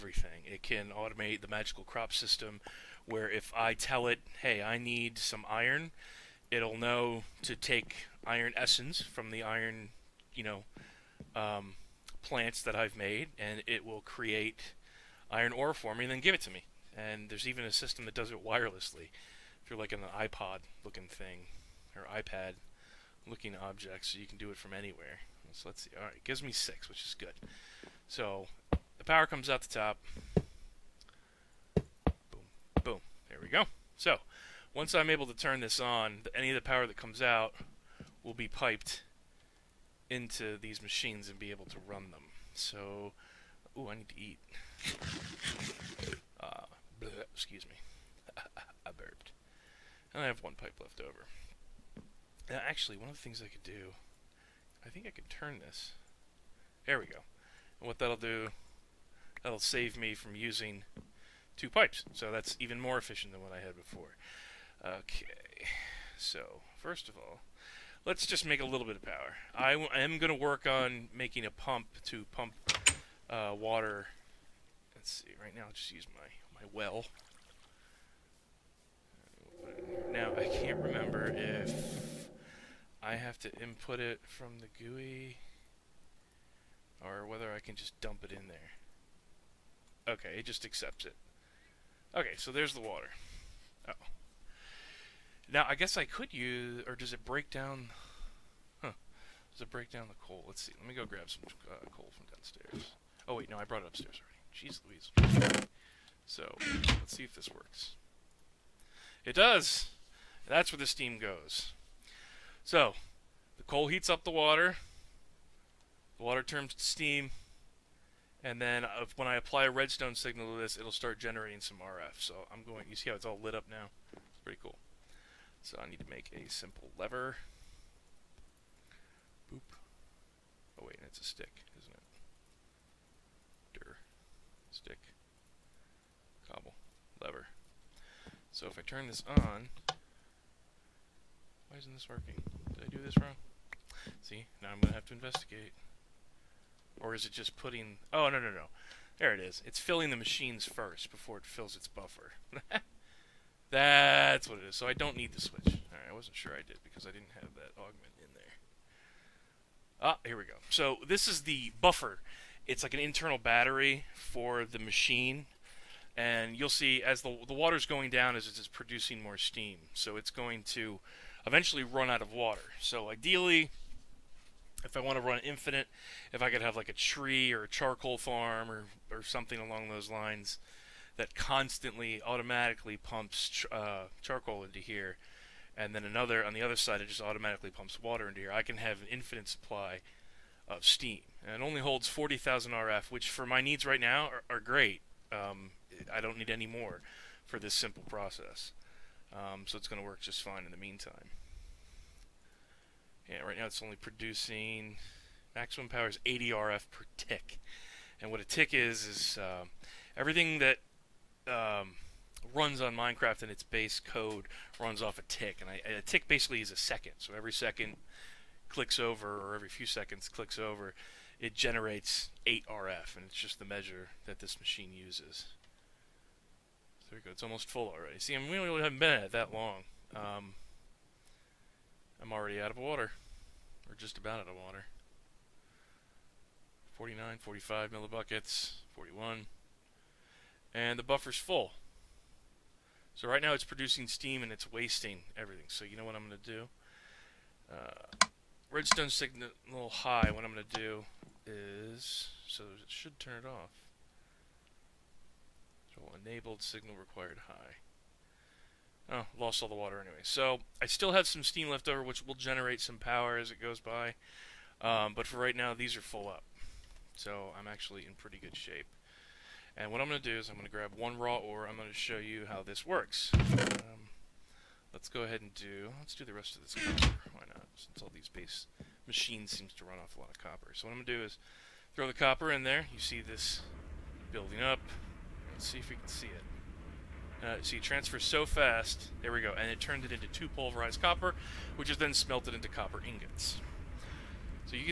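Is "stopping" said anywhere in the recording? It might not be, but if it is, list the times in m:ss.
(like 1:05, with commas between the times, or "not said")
not said.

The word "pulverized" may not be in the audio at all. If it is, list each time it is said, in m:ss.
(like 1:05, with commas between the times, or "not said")
4:50.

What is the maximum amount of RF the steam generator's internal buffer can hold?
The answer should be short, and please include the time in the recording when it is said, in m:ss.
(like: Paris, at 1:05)
40,000 RF, at 3:12.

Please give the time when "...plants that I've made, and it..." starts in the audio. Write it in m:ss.
0:12.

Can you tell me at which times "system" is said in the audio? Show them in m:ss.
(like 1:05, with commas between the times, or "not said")
0:02, 0:17.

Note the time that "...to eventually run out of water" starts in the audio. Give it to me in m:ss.
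2:50.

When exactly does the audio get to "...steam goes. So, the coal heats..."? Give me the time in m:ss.
1:50.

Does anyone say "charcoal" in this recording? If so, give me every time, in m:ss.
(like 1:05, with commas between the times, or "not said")
2:57, 3:04.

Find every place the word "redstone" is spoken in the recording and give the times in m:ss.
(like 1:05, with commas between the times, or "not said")
1:59, 4:08.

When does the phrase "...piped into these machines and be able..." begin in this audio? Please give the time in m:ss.
0:38.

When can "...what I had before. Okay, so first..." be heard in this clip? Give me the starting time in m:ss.
1:03.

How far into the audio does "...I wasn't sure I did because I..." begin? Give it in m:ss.
2:36.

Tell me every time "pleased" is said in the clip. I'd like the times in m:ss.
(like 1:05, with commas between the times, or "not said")
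not said.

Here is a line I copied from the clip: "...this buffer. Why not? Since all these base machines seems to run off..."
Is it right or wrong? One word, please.
wrong.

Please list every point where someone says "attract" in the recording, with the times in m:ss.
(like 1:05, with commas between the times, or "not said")
not said.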